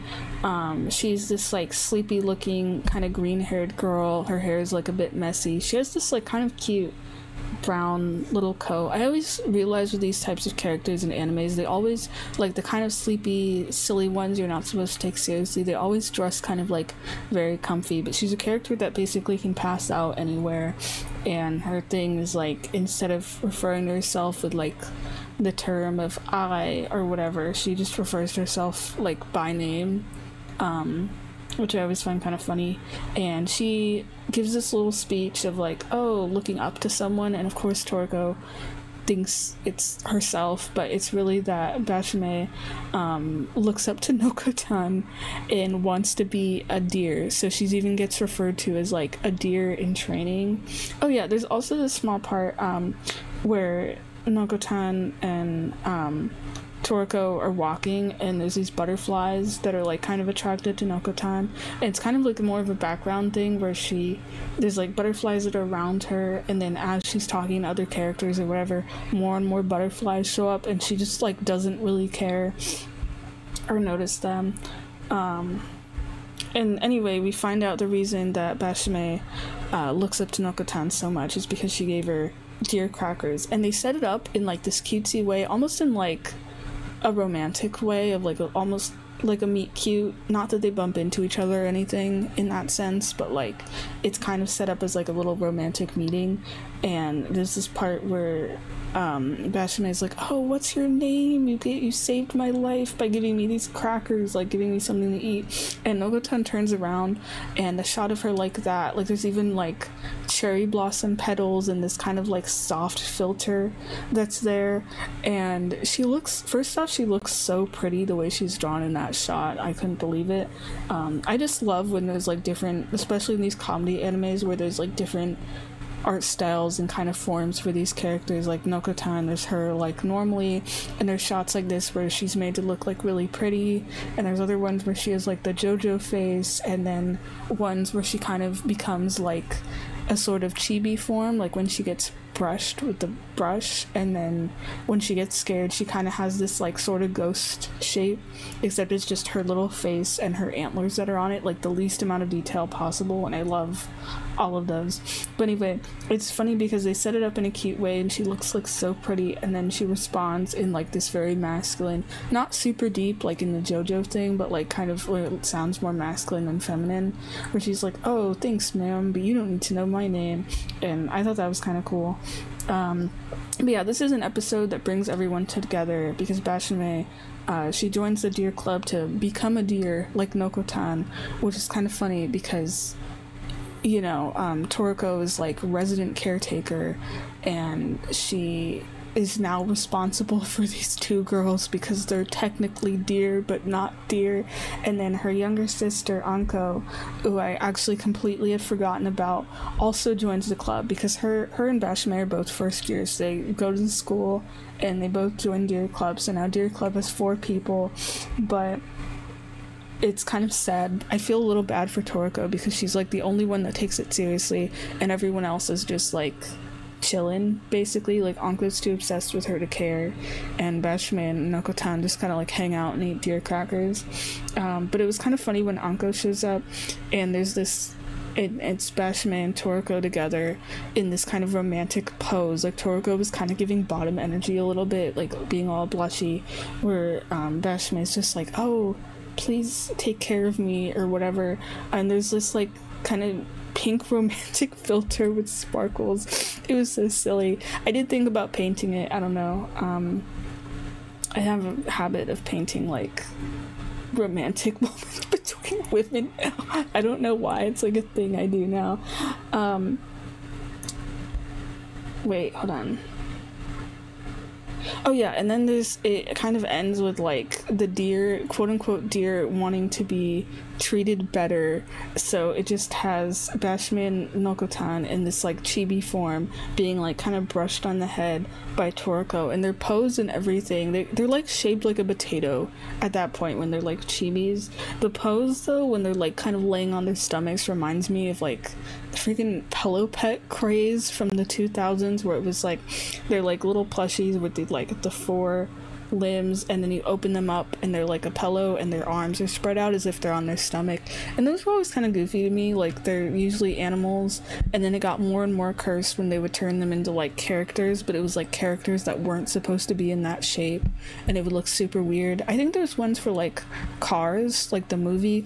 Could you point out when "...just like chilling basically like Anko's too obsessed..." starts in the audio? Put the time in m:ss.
3:35.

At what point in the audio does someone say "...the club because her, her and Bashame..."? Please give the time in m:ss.
3:20.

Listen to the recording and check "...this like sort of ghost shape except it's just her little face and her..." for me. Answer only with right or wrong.
right.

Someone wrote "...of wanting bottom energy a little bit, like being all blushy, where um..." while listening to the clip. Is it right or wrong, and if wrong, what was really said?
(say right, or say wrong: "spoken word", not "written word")
wrong: "giving", not "wanting".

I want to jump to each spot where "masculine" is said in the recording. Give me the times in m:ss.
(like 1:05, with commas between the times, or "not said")
2:41, 2:45.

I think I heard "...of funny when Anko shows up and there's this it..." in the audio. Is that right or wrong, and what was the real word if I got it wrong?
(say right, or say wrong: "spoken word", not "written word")
right.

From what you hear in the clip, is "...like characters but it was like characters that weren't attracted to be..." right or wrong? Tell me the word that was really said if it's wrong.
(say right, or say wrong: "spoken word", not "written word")
wrong: "supposed", not "attracted".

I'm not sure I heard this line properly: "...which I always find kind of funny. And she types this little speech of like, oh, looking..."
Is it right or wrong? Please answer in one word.
wrong.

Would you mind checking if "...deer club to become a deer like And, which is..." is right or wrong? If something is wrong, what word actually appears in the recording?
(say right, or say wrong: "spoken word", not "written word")
wrong: "Nokotan", not "And".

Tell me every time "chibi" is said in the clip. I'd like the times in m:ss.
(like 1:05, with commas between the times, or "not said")
2:20, 4:35, 4:44.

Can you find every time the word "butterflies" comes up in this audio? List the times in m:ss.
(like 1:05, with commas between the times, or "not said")
0:58, 1:04, 1:09.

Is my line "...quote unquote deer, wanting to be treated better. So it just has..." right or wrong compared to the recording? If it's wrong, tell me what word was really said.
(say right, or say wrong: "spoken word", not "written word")
right.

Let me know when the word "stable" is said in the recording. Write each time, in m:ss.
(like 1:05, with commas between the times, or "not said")
not said.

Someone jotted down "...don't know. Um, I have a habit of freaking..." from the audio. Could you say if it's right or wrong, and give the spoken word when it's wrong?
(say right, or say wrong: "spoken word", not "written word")
wrong: "painting", not "freaking".